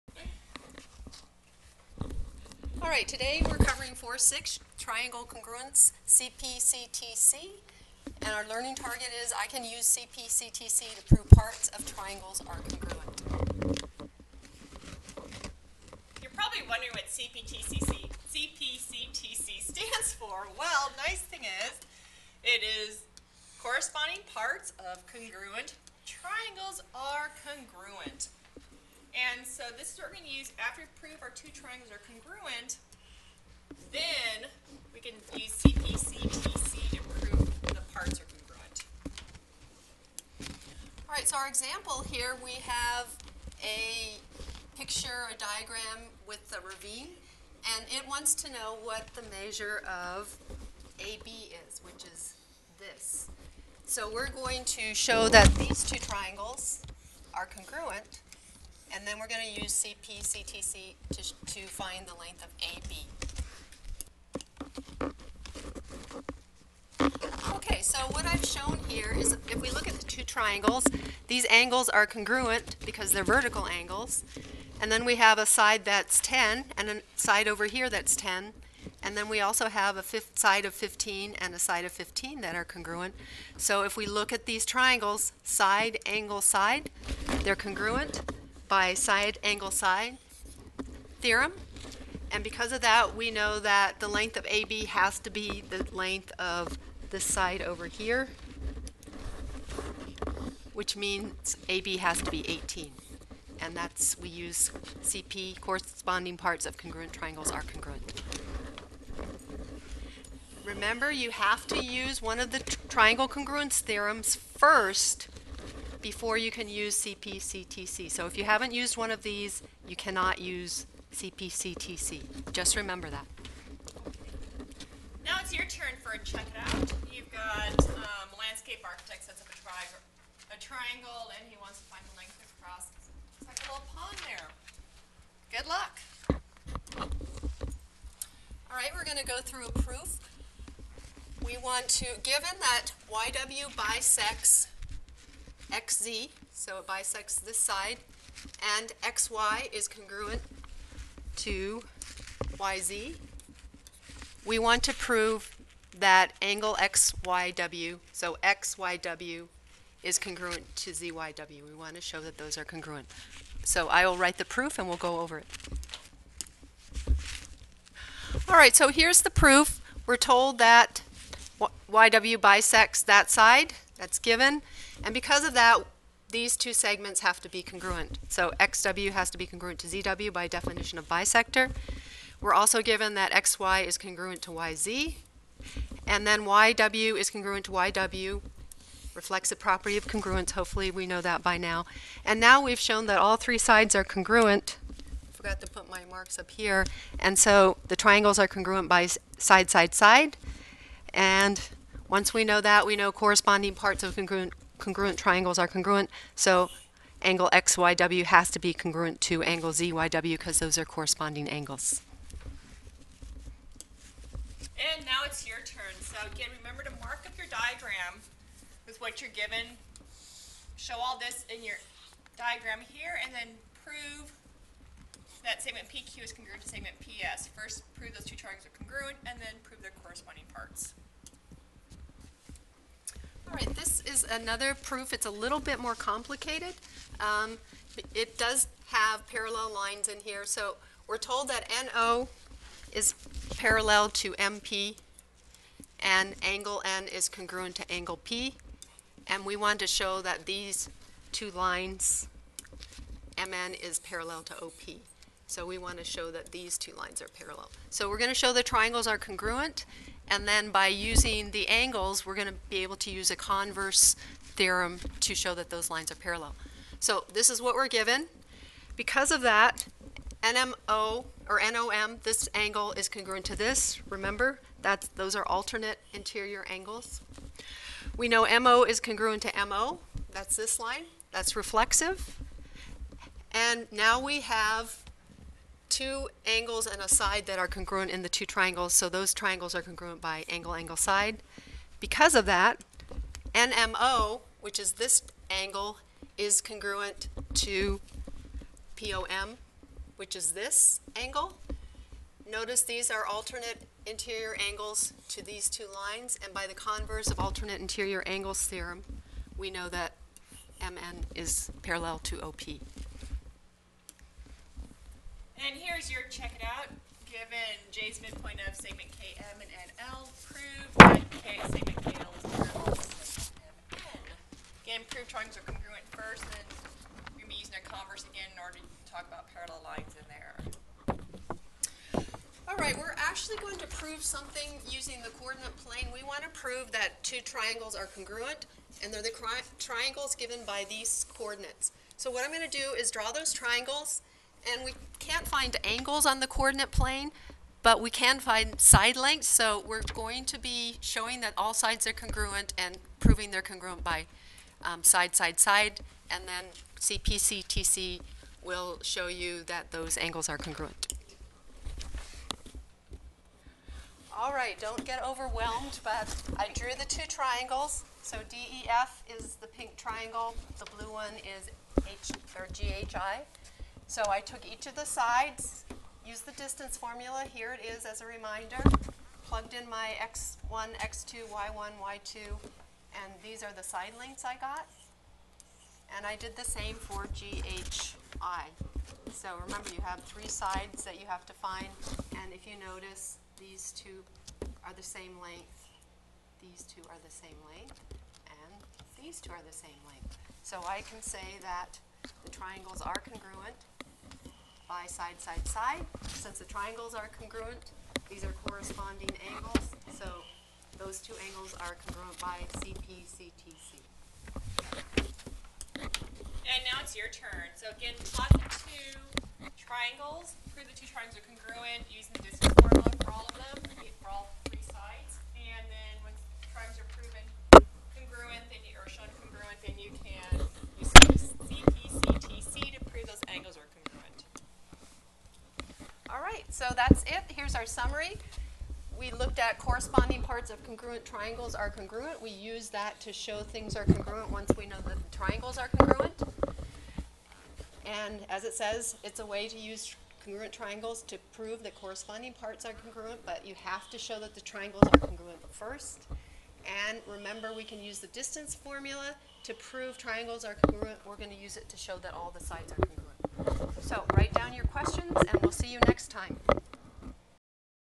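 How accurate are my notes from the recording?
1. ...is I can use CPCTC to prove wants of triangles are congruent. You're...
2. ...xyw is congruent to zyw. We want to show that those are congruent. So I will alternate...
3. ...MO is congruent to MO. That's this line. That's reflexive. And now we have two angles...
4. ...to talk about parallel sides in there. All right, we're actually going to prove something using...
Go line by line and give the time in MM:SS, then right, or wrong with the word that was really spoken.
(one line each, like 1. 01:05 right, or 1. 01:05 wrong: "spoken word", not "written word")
1. 00:09 wrong: "parts", not "wants"
2. 02:38 wrong: "write", not "alternate"
3. 04:38 right
4. 05:28 wrong: "lines", not "sides".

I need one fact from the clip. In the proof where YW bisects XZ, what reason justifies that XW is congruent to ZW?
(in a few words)
definition of bisector.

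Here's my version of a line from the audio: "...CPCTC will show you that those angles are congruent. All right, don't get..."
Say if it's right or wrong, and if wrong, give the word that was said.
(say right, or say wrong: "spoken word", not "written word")
right.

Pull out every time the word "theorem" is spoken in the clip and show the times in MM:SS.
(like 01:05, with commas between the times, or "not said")
01:31, 01:53, 04:24, 05:08.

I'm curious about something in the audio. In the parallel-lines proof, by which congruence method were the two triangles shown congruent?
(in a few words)
angle, angle, side.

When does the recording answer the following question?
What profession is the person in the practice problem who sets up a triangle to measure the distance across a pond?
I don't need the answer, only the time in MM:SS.
02:08.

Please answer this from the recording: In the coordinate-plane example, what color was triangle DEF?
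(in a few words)
pink.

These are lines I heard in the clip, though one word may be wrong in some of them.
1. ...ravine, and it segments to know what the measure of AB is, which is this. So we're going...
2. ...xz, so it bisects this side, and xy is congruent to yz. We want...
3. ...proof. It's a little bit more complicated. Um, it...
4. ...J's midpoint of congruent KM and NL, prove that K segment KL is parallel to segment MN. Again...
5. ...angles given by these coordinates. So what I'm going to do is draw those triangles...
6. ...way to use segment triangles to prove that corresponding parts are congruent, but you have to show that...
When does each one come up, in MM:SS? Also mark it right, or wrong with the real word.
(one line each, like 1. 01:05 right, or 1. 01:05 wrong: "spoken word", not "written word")
1. 00:46 wrong: "wants", not "segments"
2. 02:25 right
3. 03:54 right
4. 05:17 wrong: "segment", not "congruent"
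5. 05:39 wrong: "triangles", not "angles"
6. 07:29 wrong: "congruent", not "segment".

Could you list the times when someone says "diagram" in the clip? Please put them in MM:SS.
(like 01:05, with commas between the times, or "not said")
00:45, 03:37, 03:42.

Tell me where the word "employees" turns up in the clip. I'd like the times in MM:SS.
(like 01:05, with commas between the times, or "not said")
not said.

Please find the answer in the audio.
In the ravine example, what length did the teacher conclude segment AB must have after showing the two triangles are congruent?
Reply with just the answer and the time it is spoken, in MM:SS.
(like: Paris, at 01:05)
18, at 01:41.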